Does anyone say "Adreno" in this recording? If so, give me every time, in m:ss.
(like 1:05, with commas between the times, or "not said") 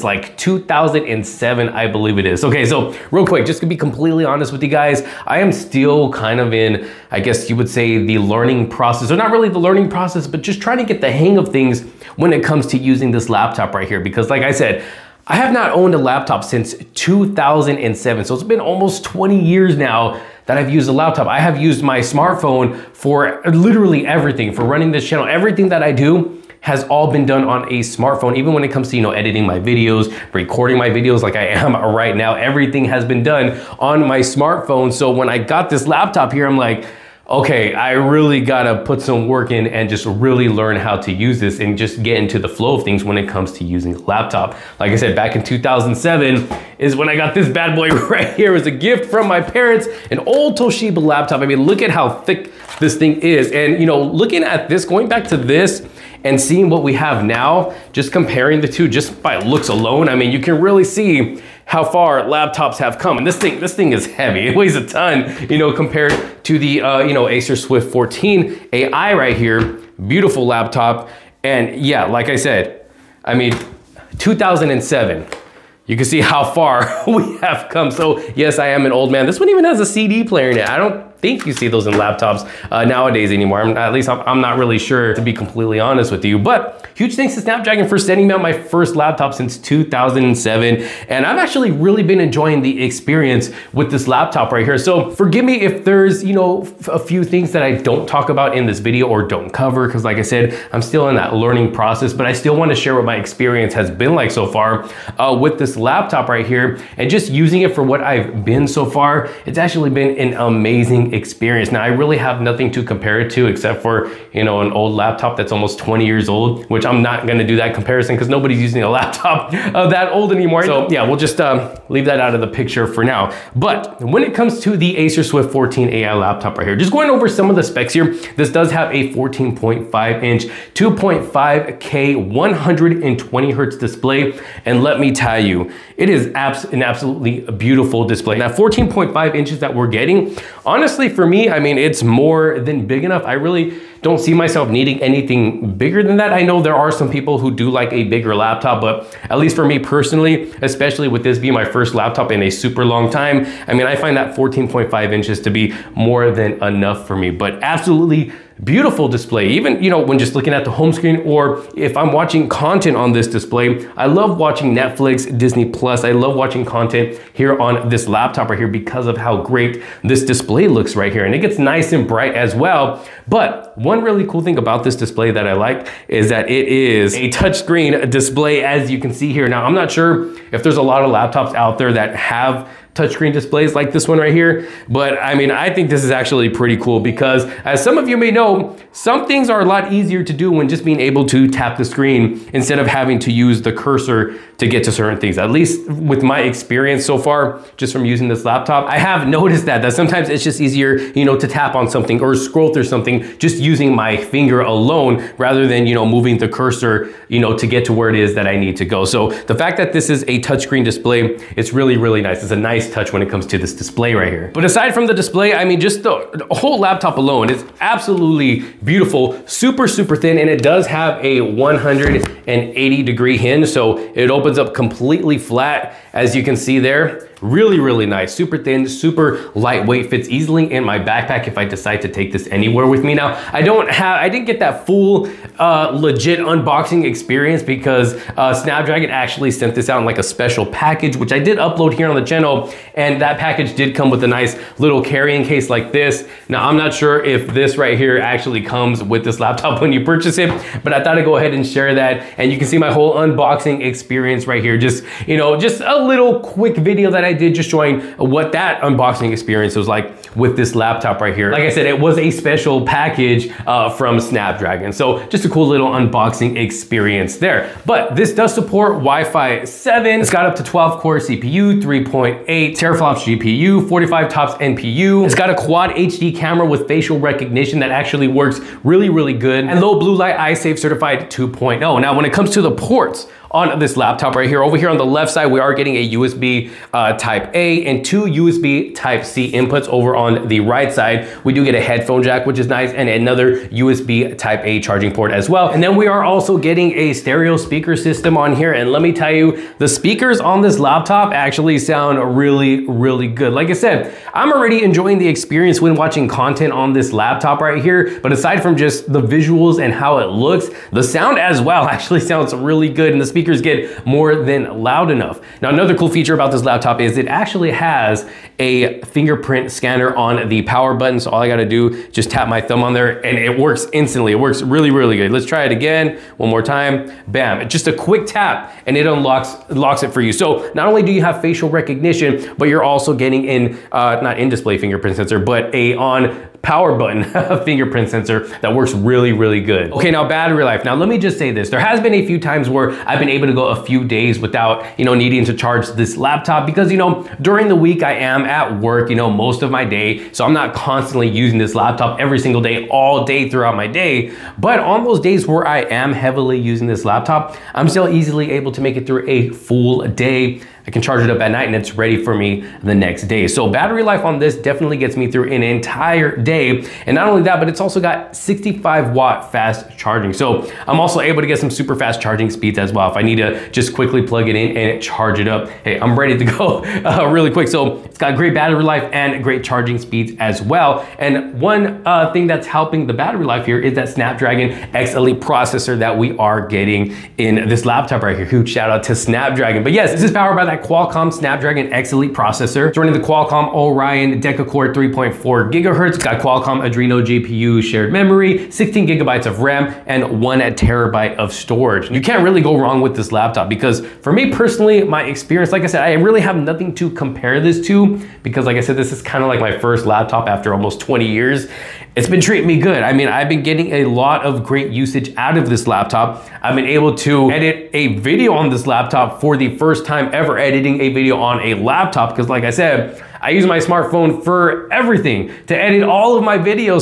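6:36.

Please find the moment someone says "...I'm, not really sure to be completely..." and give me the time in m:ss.
1:24.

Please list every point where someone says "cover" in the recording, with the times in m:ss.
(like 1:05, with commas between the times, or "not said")
1:39.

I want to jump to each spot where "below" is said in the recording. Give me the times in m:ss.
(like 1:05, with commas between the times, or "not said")
not said.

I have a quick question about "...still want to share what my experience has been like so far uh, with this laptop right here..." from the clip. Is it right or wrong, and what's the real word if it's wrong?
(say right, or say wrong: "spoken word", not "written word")
right.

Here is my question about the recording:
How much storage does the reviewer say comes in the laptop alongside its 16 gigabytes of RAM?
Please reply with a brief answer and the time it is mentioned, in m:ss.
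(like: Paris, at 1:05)
1 terabyte, at 6:40.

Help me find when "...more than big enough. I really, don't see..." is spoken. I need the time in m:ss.
2:22.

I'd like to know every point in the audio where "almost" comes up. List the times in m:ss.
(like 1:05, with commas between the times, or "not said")
0:18, 1:55, 6:50.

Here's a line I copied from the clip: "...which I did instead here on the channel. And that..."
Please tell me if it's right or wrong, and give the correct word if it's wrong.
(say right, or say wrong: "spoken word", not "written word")
wrong: "upload", not "instead".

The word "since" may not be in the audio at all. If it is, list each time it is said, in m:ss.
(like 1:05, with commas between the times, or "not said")
0:16, 1:29.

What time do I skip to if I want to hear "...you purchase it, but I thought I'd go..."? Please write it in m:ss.
4:09.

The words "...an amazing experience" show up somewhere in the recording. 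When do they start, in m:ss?
1:50.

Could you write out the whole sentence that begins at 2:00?
So yeah, we'll just um, leave that out of the picture for now.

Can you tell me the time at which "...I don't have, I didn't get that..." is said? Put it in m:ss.
3:53.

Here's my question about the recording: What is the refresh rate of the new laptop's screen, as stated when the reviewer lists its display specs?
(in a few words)
120 hertz.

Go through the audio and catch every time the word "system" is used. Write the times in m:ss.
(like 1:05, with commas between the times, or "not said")
4:57.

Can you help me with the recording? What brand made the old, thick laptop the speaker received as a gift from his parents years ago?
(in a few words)
Toshiba.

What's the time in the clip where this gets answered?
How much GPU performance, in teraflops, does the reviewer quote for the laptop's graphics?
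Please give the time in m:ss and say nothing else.
4:31.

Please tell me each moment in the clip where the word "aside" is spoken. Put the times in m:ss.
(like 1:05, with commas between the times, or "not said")
3:34, 5:08.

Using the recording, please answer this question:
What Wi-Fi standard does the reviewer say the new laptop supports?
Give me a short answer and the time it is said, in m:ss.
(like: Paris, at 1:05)
Wi-Fi 7, at 4:28.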